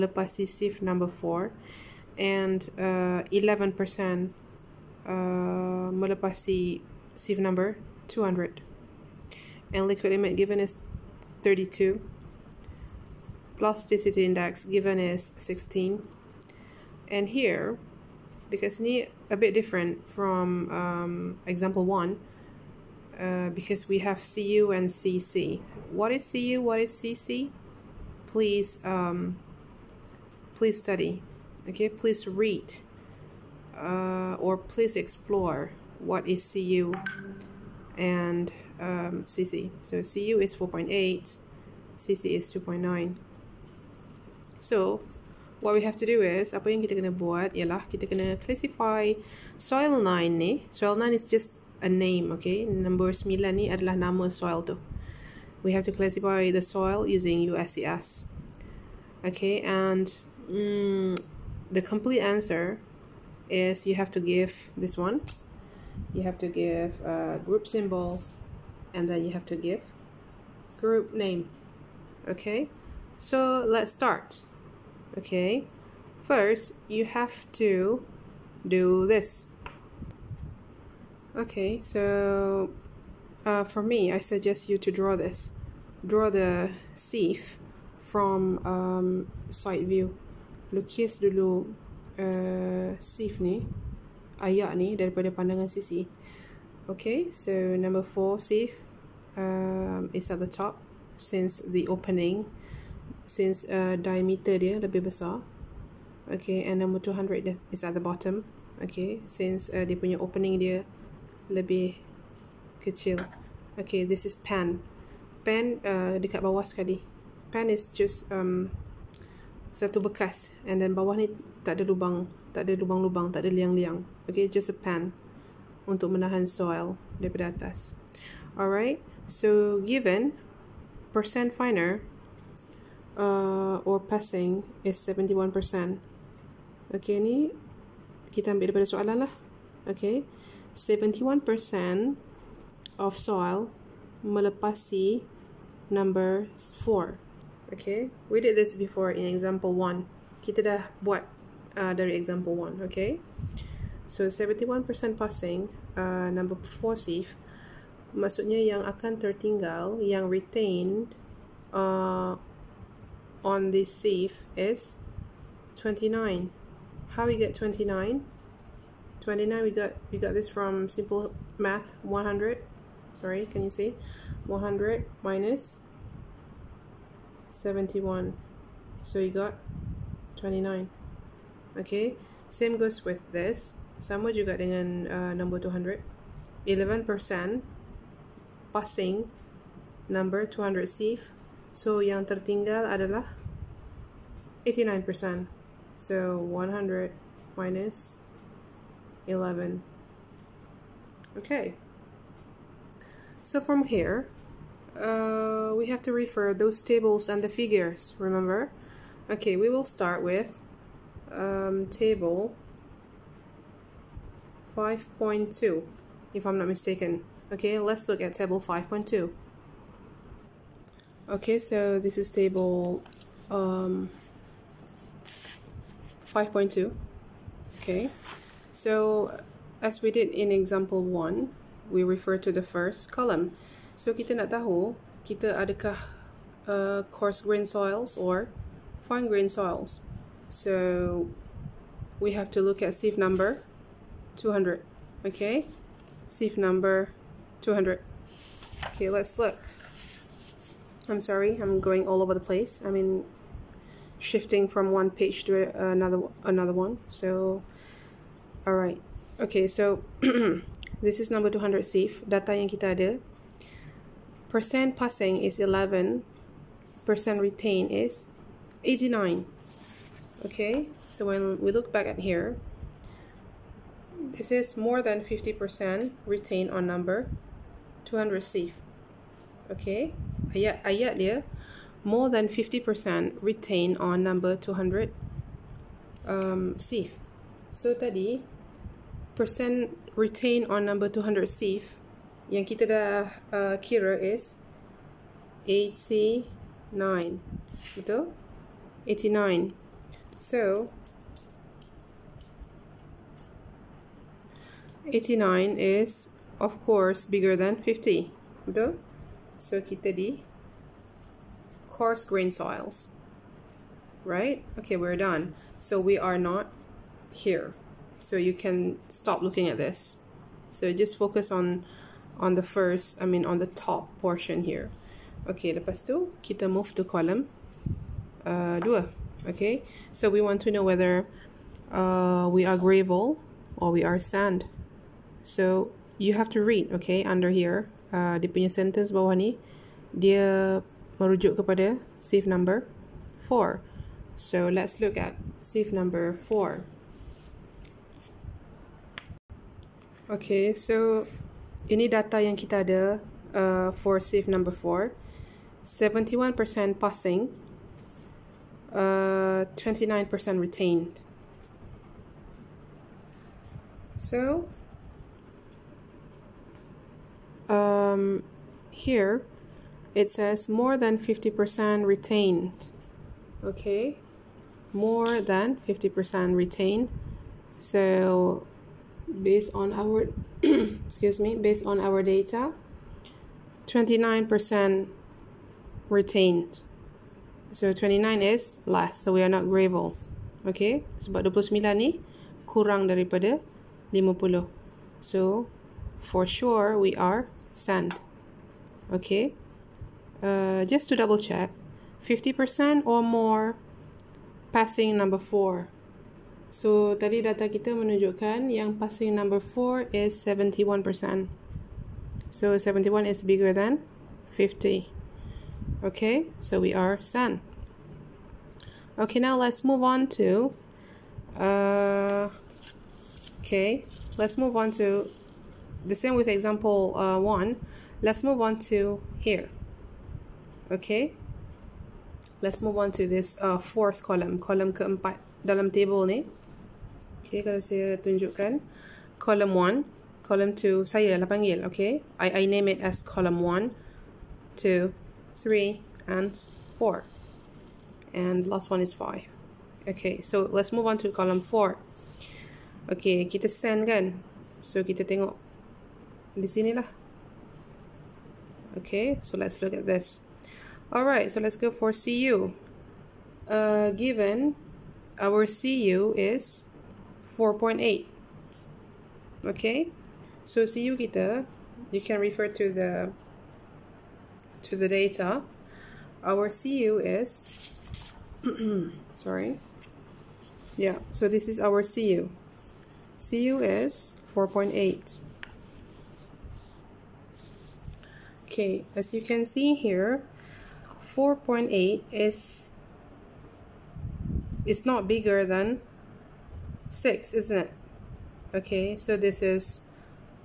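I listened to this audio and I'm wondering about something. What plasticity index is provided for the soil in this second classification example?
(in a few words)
16.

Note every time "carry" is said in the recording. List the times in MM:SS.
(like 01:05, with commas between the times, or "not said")
not said.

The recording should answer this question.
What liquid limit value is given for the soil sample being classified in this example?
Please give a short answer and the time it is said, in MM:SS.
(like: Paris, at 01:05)
32, at 00:11.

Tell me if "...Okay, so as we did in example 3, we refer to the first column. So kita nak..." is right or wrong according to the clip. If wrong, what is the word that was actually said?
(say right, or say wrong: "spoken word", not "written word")
wrong: "1", not "3".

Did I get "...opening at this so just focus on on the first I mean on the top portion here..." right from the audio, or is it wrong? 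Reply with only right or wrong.
wrong.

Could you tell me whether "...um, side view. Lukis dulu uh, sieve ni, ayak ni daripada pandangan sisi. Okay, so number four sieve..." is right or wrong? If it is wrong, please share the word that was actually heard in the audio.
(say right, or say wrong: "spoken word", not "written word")
right.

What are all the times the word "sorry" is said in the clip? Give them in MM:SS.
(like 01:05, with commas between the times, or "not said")
04:11, 07:59.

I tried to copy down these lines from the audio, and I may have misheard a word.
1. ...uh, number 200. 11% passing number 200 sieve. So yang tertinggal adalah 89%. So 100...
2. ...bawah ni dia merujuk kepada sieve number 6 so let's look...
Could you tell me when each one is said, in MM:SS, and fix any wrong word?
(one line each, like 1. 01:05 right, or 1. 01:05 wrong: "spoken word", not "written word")
1. 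03:05 right
2. 05:39 wrong: "4", not "6".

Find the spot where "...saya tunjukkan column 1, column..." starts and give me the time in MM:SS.
07:17.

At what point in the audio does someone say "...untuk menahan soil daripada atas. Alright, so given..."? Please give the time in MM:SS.
02:05.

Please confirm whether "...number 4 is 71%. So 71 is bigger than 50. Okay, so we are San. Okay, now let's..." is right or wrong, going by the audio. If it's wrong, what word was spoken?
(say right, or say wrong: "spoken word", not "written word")
right.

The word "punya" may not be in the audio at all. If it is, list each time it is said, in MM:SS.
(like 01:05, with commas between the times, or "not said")
01:49, 05:38.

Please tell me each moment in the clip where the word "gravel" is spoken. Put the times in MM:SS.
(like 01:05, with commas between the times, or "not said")
05:32, 06:29.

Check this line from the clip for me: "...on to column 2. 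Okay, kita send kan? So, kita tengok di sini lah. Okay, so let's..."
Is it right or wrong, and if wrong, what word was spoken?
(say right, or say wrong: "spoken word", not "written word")
wrong: "4", not "2".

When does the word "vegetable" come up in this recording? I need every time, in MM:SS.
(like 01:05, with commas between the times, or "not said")
not said.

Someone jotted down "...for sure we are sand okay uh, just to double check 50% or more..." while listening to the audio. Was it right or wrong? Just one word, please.
right.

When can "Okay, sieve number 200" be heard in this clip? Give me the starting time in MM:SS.
04:05.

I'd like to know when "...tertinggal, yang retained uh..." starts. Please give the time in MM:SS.
02:39.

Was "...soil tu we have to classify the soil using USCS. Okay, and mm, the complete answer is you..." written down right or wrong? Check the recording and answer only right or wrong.
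right.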